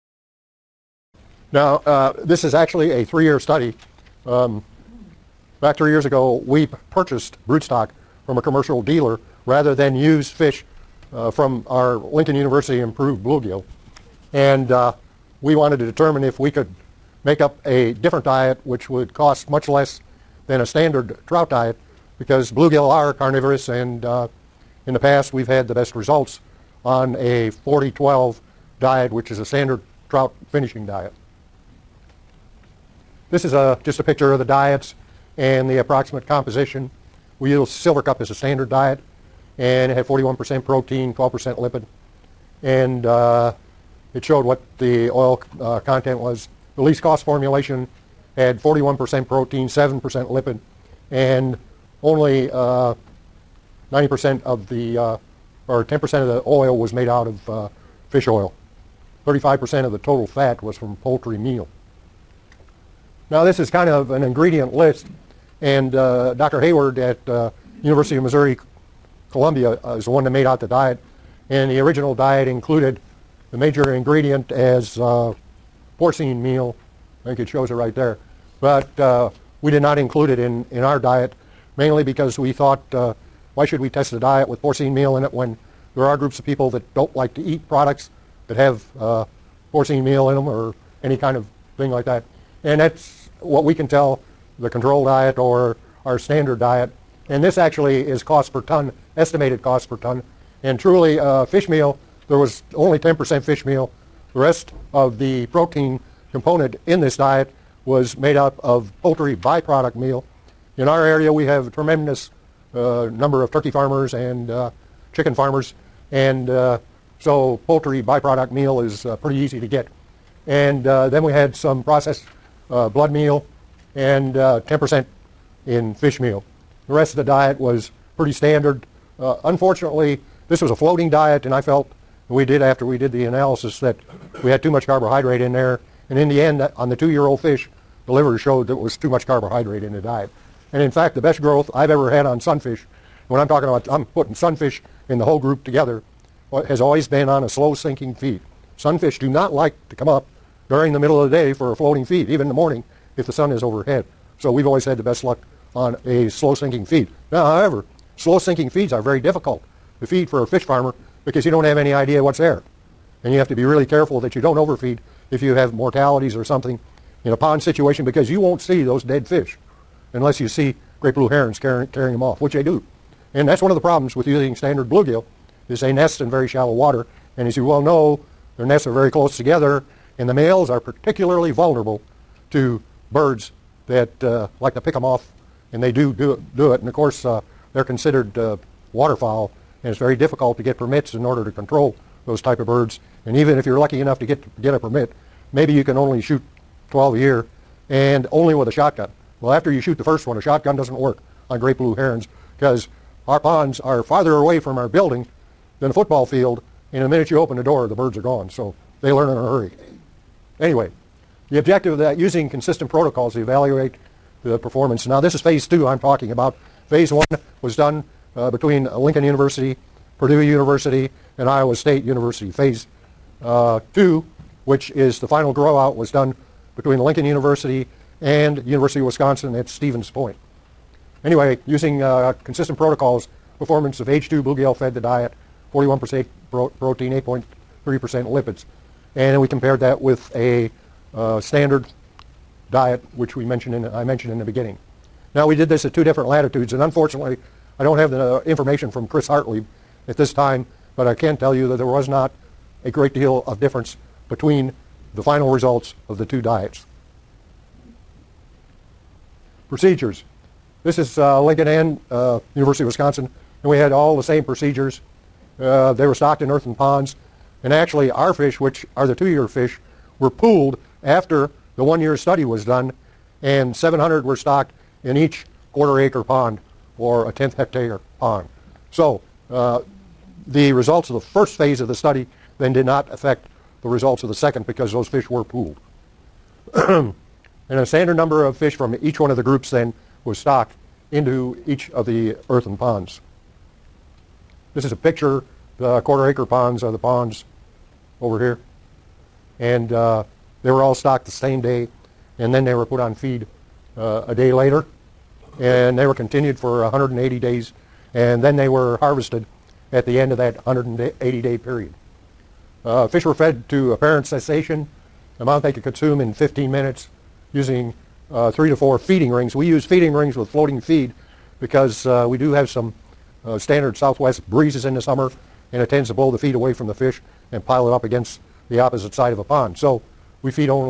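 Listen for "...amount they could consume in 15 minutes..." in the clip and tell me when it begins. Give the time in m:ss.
5:15.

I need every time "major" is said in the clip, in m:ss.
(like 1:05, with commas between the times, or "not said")
1:13.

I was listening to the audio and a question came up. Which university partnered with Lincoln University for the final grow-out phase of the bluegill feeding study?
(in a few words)
University of Wisconsin at Stevens Point.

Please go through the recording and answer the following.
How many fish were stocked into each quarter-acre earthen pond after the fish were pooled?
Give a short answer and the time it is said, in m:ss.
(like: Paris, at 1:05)
700, at 4:33.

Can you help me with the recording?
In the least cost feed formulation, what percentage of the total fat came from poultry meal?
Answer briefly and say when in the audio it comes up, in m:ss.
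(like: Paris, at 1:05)
35%, at 0:59.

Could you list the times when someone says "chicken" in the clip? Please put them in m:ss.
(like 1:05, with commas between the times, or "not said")
1:55.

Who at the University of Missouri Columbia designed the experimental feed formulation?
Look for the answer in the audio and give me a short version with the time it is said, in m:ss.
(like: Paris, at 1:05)
Dr. Hayward, at 1:06.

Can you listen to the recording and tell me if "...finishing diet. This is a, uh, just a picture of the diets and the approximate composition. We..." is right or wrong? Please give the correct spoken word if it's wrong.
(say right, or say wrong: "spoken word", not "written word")
right.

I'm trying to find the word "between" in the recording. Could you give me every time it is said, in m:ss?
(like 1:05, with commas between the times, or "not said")
3:38, 3:46, 4:14.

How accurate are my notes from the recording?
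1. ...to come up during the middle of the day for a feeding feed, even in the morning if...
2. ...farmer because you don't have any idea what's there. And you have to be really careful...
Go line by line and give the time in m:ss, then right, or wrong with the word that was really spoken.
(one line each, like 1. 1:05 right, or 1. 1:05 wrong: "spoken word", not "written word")
1. 2:29 wrong: "floating", not "feeding"
2. 2:40 right.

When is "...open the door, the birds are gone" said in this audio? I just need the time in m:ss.
3:27.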